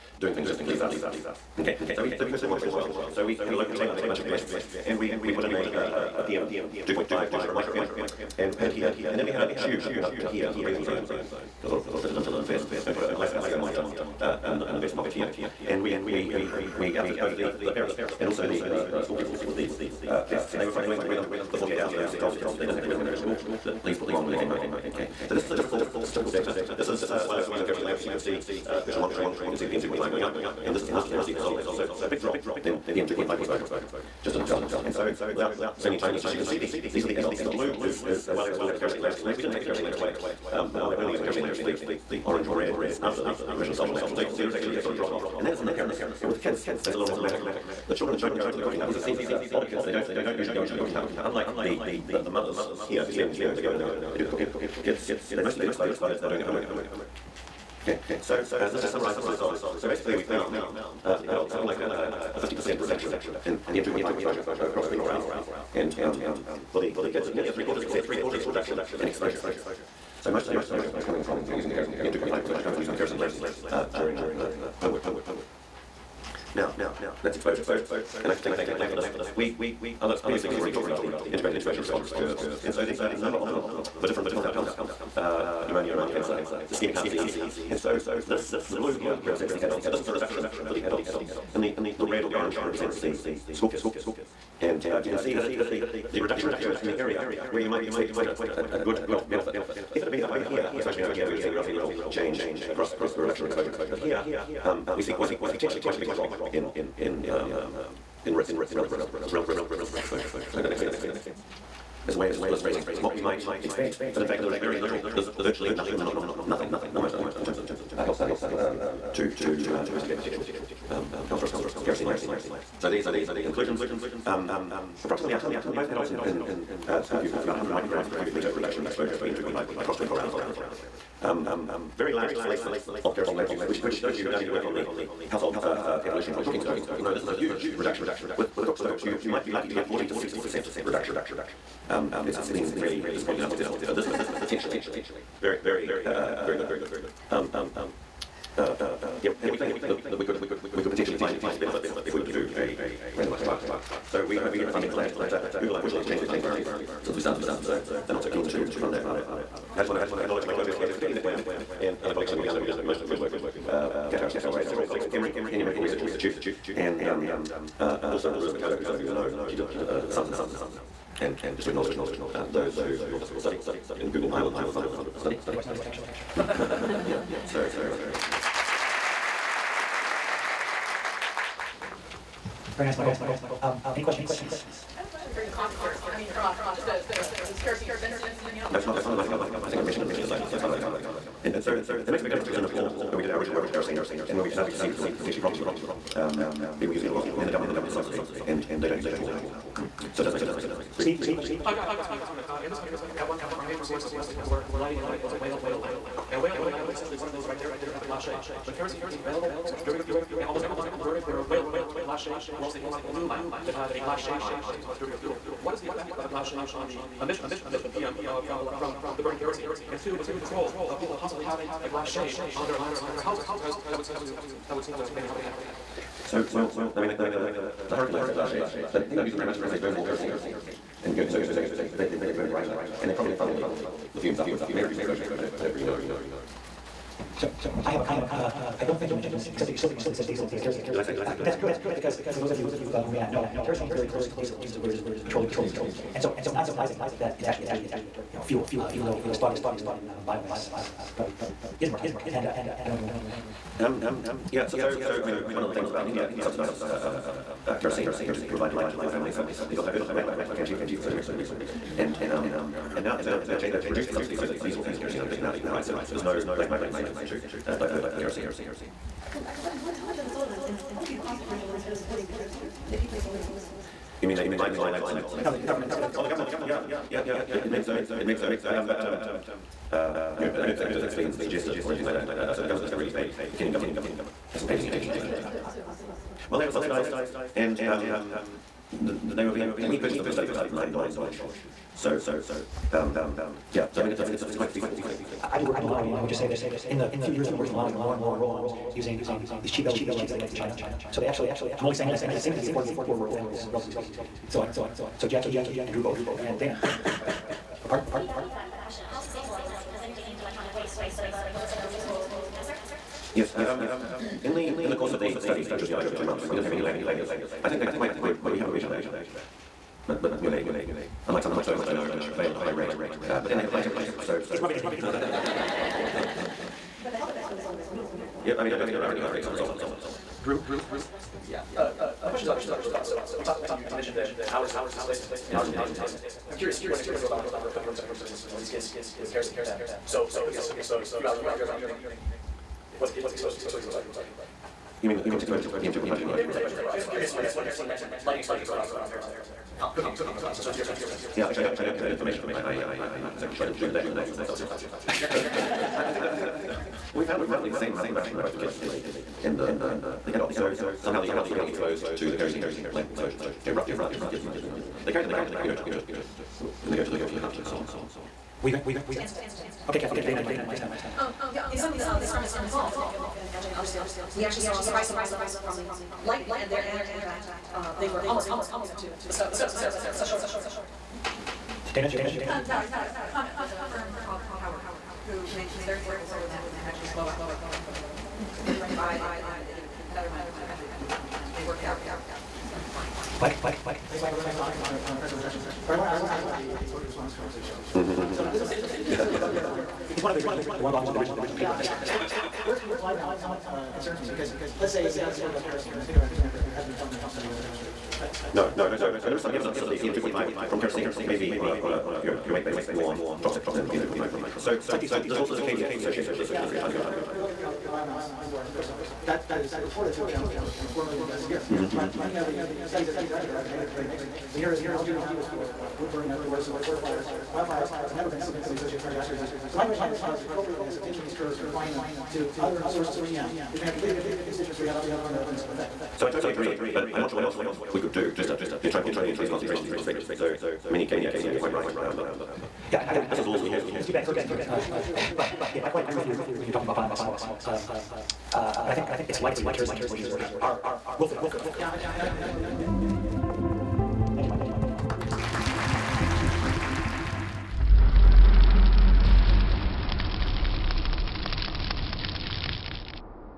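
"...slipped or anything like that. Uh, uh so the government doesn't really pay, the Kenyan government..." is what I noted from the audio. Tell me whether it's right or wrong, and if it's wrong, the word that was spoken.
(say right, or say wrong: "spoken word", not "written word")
wrong: "suggested", not "slipped".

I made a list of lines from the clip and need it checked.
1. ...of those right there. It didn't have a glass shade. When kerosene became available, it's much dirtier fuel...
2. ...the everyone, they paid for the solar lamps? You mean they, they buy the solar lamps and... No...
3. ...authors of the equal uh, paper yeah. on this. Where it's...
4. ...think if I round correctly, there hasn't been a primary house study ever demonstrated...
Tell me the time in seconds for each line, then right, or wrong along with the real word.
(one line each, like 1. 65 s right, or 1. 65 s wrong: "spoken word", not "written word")
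1. 207 s right
2. 272 s wrong: "kerosene", not "everyone"
3. 400 s wrong: "original", not "equal"
4. 406 s wrong: "understand", not "round".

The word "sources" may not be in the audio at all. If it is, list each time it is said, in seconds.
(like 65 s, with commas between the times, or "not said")
203 s, 350 s, 432 s.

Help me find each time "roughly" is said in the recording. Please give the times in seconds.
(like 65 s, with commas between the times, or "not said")
357 s, 363 s.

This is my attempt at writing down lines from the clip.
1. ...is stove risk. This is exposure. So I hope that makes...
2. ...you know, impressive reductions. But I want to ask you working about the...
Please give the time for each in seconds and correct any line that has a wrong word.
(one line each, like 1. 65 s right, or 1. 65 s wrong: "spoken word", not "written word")
1. 109 s wrong: "relative", not "stove"
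2. 395 s wrong: "something", not "working".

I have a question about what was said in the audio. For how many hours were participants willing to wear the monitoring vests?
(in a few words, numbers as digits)
48.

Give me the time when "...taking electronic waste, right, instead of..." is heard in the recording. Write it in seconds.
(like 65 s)
310 s.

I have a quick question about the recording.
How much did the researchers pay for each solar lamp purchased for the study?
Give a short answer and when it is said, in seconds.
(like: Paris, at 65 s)
9 dollars, at 290 s.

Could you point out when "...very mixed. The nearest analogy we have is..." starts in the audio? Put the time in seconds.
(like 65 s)
423 s.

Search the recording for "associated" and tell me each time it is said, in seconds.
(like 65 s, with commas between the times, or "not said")
415 s, 428 s.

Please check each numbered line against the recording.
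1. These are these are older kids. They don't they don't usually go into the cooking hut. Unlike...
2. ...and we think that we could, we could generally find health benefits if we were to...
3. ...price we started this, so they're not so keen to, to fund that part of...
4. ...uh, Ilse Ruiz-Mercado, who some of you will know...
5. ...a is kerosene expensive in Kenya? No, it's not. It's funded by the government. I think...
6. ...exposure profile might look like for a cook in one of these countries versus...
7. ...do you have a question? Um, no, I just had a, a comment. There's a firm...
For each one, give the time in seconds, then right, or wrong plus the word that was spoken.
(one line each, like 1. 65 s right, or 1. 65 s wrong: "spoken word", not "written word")
1. 48 s right
2. 149 s wrong: "potentially", not "generally"
3. 157 s wrong: "since", not "price"
4. 167 s right
5. 186 s right
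6. 336 s right
7. 382 s right.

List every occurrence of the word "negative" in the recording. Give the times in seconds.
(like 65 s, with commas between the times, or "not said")
423 s.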